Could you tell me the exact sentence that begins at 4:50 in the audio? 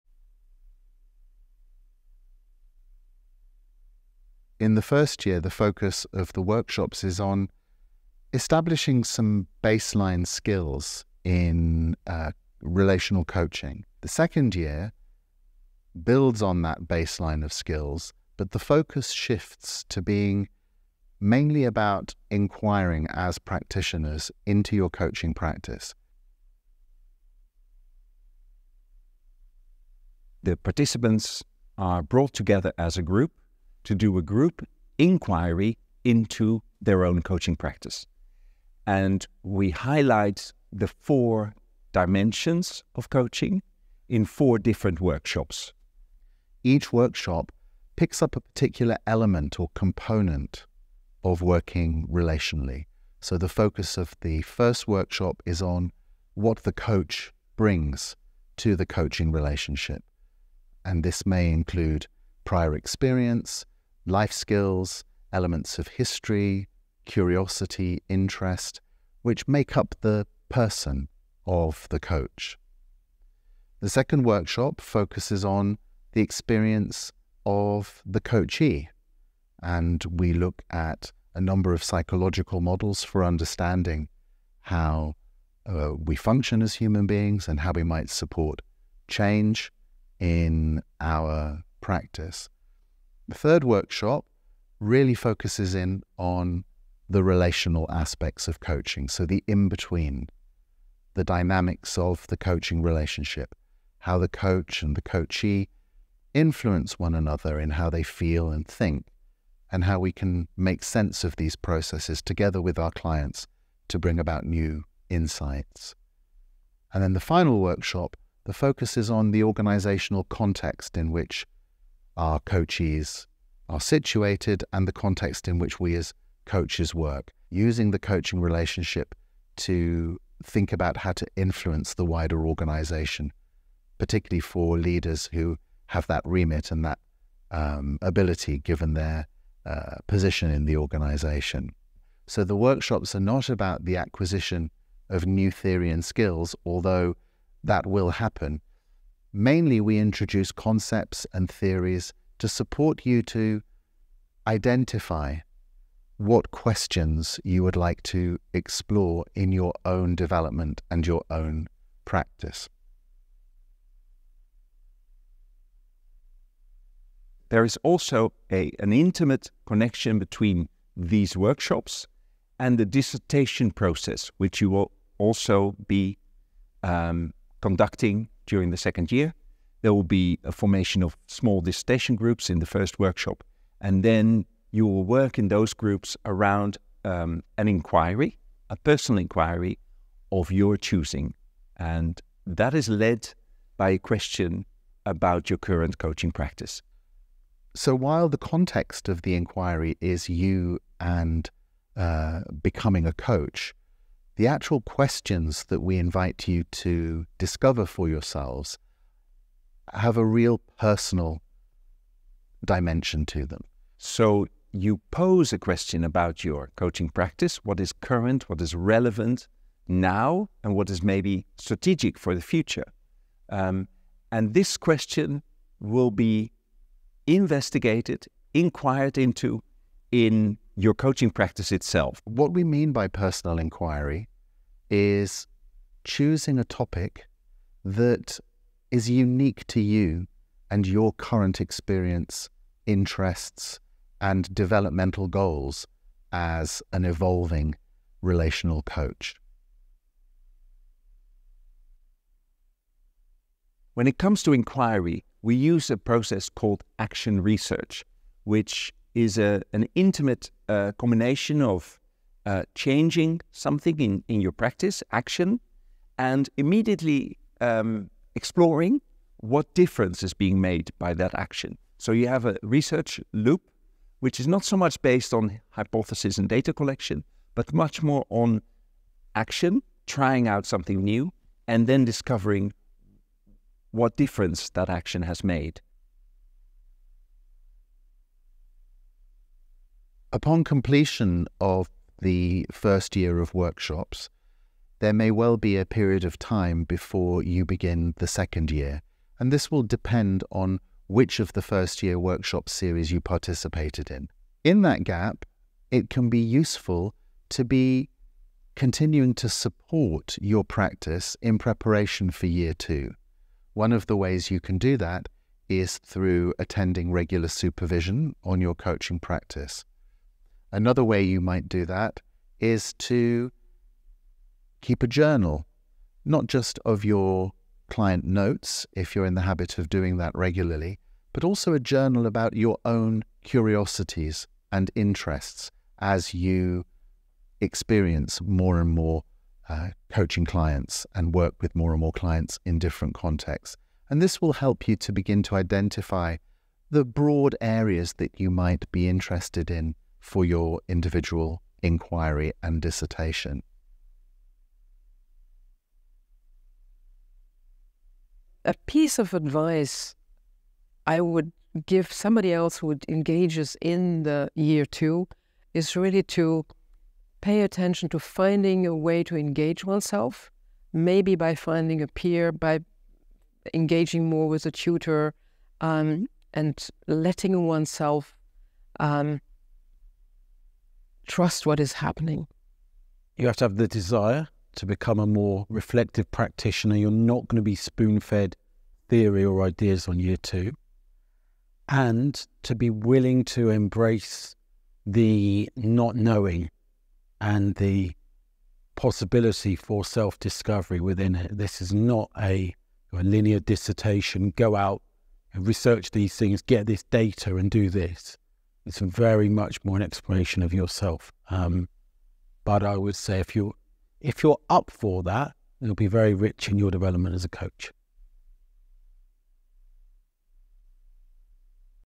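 Upon completion of the first year of workshops, there may well be a period of time before you begin the second year.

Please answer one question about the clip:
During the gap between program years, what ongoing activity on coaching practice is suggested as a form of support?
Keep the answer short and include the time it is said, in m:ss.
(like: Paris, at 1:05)
supervision, at 5:17.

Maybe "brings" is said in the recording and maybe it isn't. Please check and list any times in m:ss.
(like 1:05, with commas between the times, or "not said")
0:57, 1:53.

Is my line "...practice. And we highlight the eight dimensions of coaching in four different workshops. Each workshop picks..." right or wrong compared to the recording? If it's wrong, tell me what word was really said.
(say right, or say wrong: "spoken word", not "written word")
wrong: "four", not "eight".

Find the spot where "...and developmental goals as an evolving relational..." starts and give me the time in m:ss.
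4:04.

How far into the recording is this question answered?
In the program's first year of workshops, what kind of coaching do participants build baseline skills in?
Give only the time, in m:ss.
0:12.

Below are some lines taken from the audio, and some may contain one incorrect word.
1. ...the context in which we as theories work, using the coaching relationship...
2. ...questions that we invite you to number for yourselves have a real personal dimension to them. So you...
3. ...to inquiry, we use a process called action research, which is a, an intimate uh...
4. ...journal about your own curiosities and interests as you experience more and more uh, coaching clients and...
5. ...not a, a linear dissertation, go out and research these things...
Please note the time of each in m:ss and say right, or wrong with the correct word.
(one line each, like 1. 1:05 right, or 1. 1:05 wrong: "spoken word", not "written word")
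1. 2:04 wrong: "coaches", not "theories"
2. 3:24 wrong: "discover", not "number"
3. 4:14 right
4. 5:31 right
5. 6:41 right.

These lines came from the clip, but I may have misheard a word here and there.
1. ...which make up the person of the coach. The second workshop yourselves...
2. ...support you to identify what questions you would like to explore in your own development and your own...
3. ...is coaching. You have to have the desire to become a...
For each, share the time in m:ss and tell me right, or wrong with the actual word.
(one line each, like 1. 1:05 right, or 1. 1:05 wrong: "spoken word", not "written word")
1. 1:09 wrong: "focuses", not "yourselves"
2. 2:32 right
3. 6:21 wrong: "happening", not "coaching".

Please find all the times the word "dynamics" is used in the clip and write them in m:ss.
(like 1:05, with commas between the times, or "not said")
1:41.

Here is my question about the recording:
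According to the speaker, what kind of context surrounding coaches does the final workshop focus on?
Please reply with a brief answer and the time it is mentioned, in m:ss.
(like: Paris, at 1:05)
organizational context, at 1:59.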